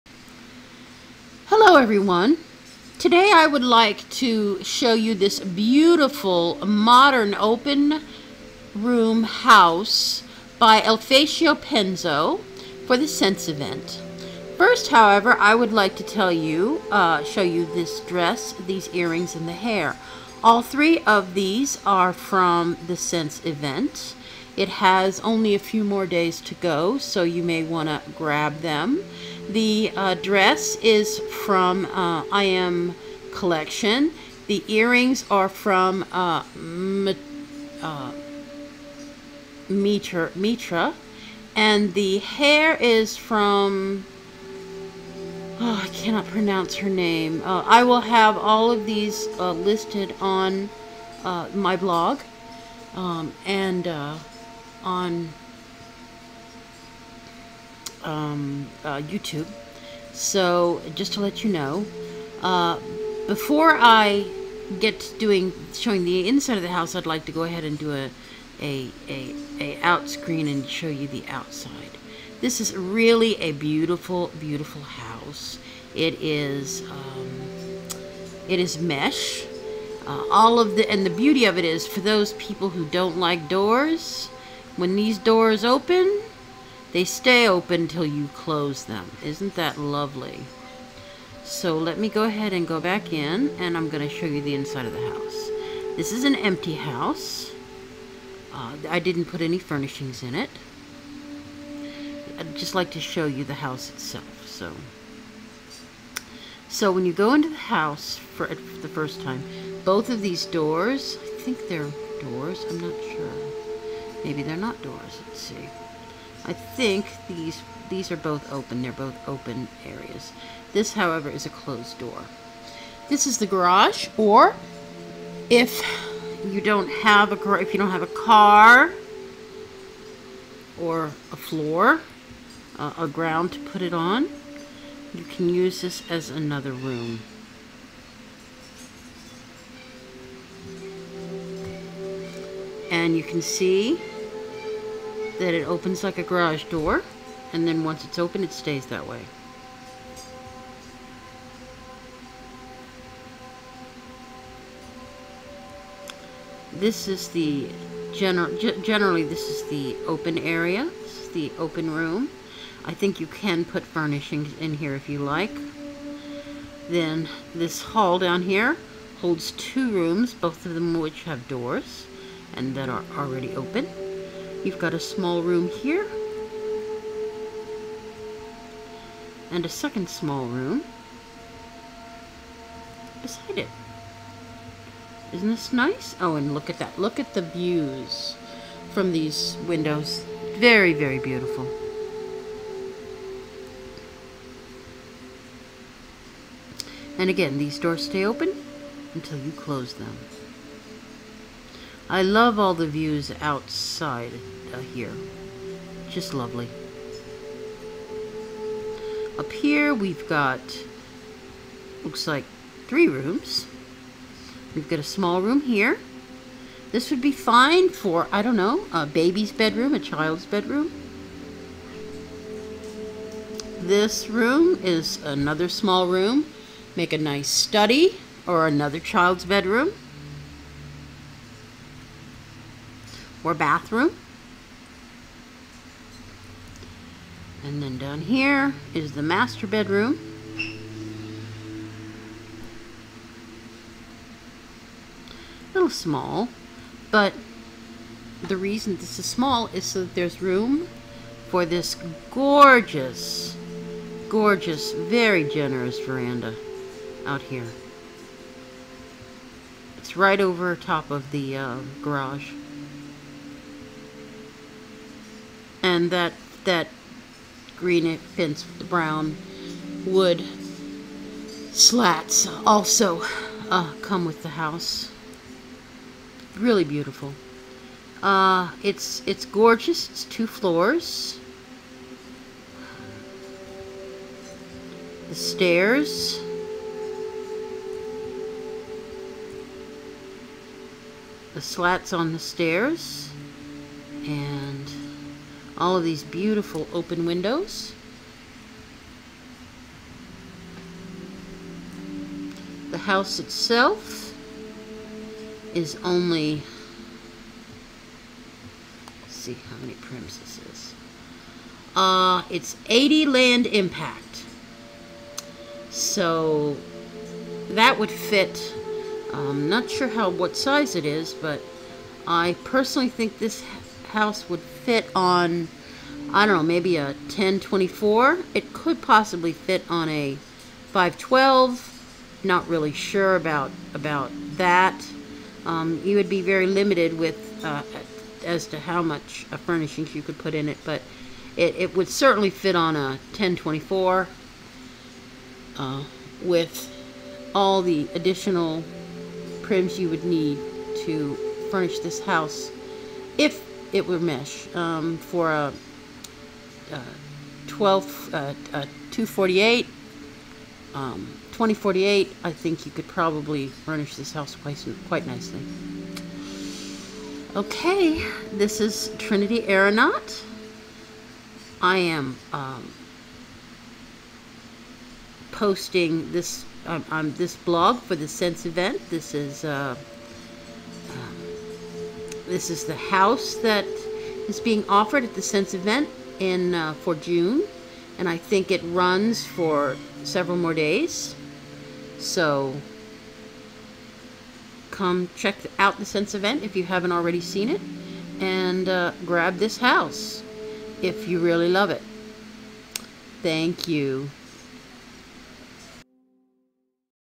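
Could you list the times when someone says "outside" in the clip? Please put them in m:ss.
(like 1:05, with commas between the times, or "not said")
1:11, 3:23.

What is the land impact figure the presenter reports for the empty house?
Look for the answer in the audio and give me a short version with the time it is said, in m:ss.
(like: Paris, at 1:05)
80, at 5:12.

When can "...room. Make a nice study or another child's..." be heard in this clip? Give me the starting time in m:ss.
3:46.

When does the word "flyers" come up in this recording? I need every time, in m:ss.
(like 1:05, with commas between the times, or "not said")
not said.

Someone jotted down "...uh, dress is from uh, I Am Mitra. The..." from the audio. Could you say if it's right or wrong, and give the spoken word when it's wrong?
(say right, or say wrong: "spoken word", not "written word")
wrong: "Collection", not "Mitra".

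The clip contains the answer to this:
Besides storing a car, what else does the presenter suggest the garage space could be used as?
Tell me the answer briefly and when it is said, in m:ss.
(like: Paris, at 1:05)
Another room, at 2:16.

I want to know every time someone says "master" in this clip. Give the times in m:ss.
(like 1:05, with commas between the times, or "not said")
3:59.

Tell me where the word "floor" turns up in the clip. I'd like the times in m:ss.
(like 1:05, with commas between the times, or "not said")
2:11, 4:40.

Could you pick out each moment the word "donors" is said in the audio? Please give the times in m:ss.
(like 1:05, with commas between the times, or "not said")
not said.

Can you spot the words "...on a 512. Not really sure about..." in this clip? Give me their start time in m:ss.
5:29.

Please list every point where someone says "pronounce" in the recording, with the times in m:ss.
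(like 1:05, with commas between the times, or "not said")
0:46.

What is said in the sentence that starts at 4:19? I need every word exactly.
It's right over top of the uh, garage.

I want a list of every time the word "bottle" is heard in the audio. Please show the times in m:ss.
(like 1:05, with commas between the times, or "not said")
not said.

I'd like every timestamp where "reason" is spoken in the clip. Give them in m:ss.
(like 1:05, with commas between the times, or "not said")
4:08.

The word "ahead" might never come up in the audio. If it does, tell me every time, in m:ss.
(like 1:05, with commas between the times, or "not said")
1:07, 1:32.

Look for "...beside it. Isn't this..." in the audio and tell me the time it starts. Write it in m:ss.
3:03.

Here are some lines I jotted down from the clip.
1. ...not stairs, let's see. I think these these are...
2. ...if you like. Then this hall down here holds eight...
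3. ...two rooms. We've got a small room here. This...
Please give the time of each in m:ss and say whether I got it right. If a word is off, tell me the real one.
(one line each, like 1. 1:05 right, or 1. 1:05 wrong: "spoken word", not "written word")
1. 1:54 wrong: "doors", not "stairs"
2. 2:44 wrong: "two", not "eight"
3. 3:32 wrong: "three", not "two".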